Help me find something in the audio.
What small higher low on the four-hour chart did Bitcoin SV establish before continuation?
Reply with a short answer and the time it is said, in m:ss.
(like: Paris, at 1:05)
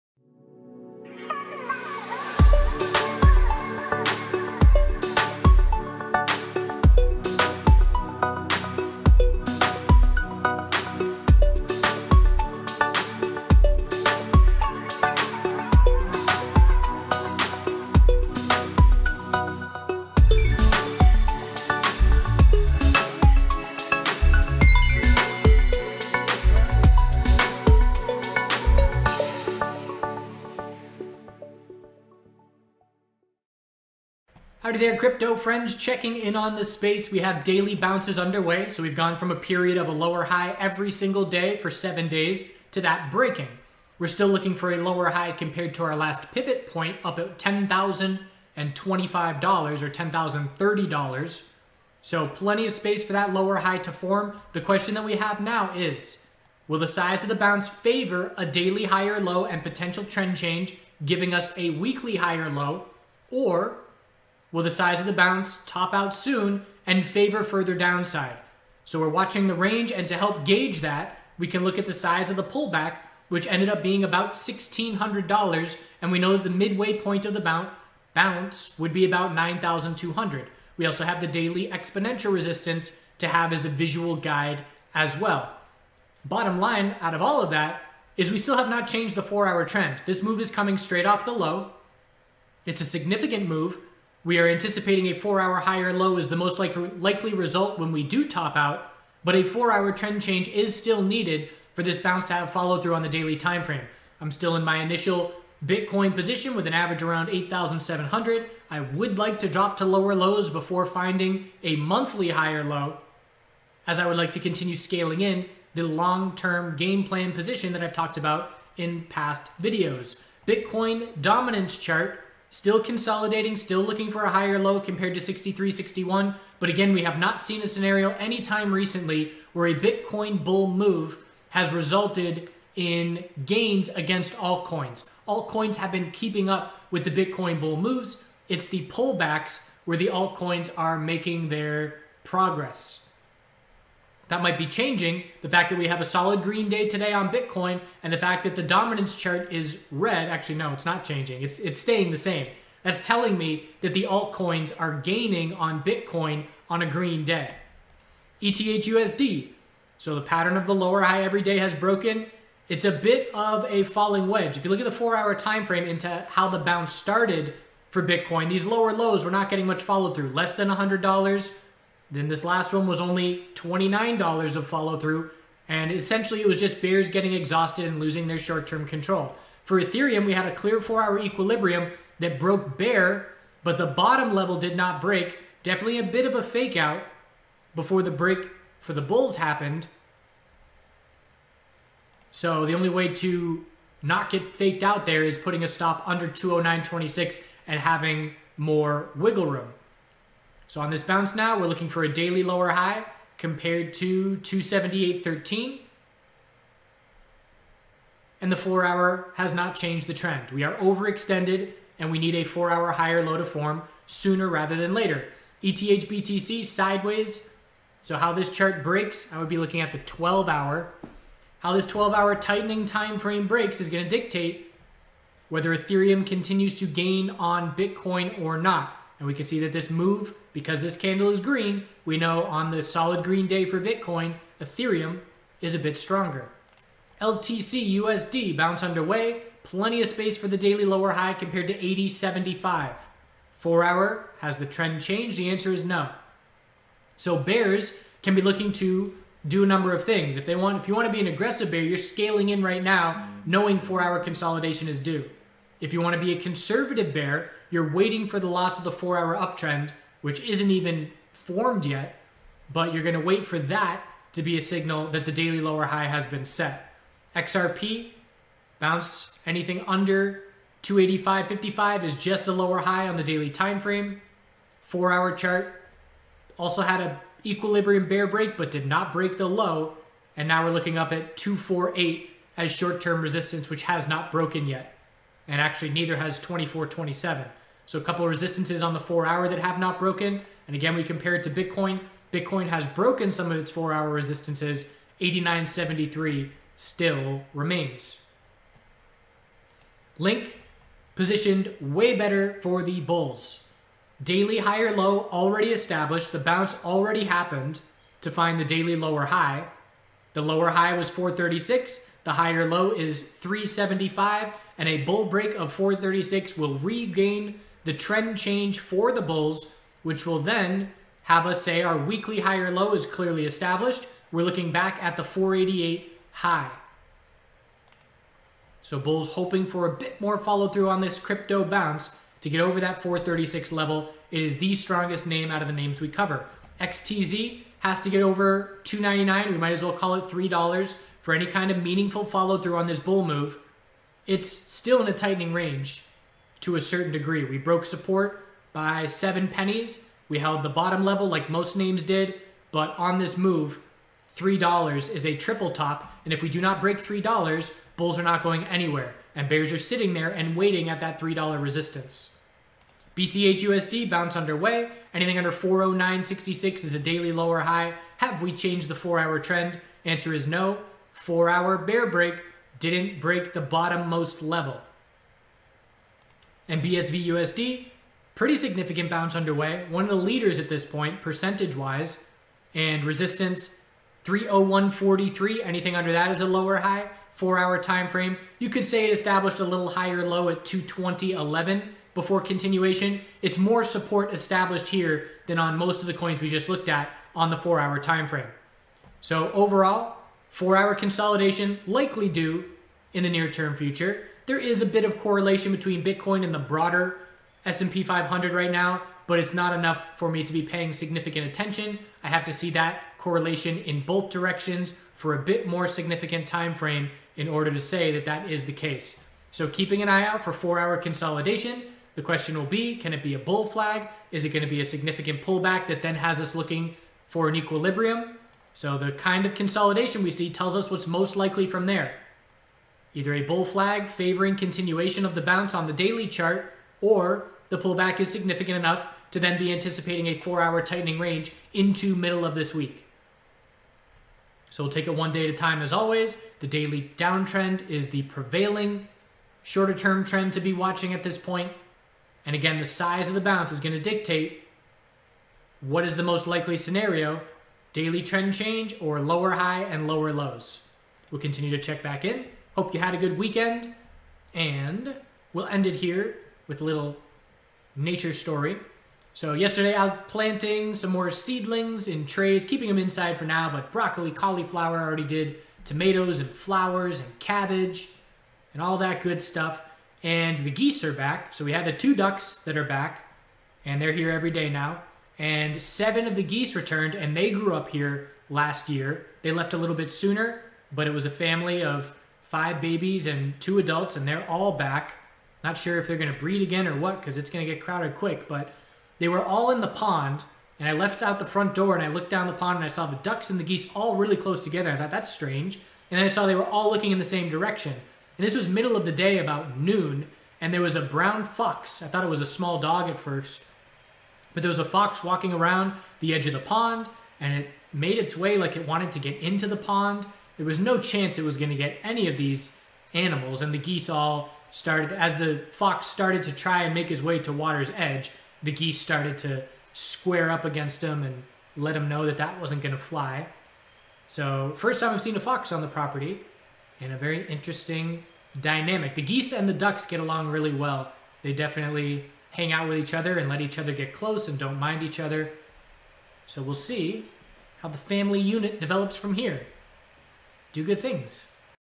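220.11, at 6:30.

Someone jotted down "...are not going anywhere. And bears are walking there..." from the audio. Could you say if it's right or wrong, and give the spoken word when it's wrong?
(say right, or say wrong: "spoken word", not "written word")
wrong: "sitting", not "walking".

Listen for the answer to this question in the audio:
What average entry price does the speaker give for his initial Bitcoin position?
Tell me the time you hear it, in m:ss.
1:47.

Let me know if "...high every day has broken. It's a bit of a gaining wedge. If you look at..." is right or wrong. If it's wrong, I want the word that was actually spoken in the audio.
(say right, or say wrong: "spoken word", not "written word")
wrong: "falling", not "gaining".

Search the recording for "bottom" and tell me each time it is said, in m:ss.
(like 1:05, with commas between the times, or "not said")
1:26, 3:03, 5:50, 6:13.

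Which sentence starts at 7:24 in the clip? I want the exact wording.
So we'll take it one day at a time as always.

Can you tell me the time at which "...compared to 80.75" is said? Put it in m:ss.
4:01.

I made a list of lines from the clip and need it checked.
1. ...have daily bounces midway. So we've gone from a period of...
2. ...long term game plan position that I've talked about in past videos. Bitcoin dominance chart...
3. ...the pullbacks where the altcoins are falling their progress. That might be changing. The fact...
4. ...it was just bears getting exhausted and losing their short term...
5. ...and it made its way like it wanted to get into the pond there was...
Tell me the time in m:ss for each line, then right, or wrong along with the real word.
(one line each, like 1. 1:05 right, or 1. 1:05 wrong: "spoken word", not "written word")
1. 0:37 wrong: "underway", not "midway"
2. 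1:55 right
3. 2:18 wrong: "making", not "falling"
4. 2:56 right
5. 8:37 right.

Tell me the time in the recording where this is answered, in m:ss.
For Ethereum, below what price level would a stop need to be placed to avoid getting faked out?
3:16.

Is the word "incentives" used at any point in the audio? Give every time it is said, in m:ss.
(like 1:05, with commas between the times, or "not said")
not said.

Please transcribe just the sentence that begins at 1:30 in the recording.
This move is coming straight off the low.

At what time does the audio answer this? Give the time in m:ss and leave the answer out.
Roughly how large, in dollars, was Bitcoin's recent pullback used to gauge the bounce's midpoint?
1:14.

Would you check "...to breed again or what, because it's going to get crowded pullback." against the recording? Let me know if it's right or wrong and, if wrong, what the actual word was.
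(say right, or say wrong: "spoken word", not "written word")
wrong: "quick", not "pullback".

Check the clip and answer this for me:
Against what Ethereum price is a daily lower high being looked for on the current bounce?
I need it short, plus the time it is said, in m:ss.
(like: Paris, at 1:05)
278.13, at 3:24.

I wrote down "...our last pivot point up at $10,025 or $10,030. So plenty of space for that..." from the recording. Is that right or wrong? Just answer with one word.
right.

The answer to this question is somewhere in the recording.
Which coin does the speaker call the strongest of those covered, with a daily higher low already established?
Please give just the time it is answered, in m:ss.
5:00.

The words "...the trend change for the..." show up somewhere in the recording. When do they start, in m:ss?
5:17.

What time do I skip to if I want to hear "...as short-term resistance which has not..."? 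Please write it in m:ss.
4:42.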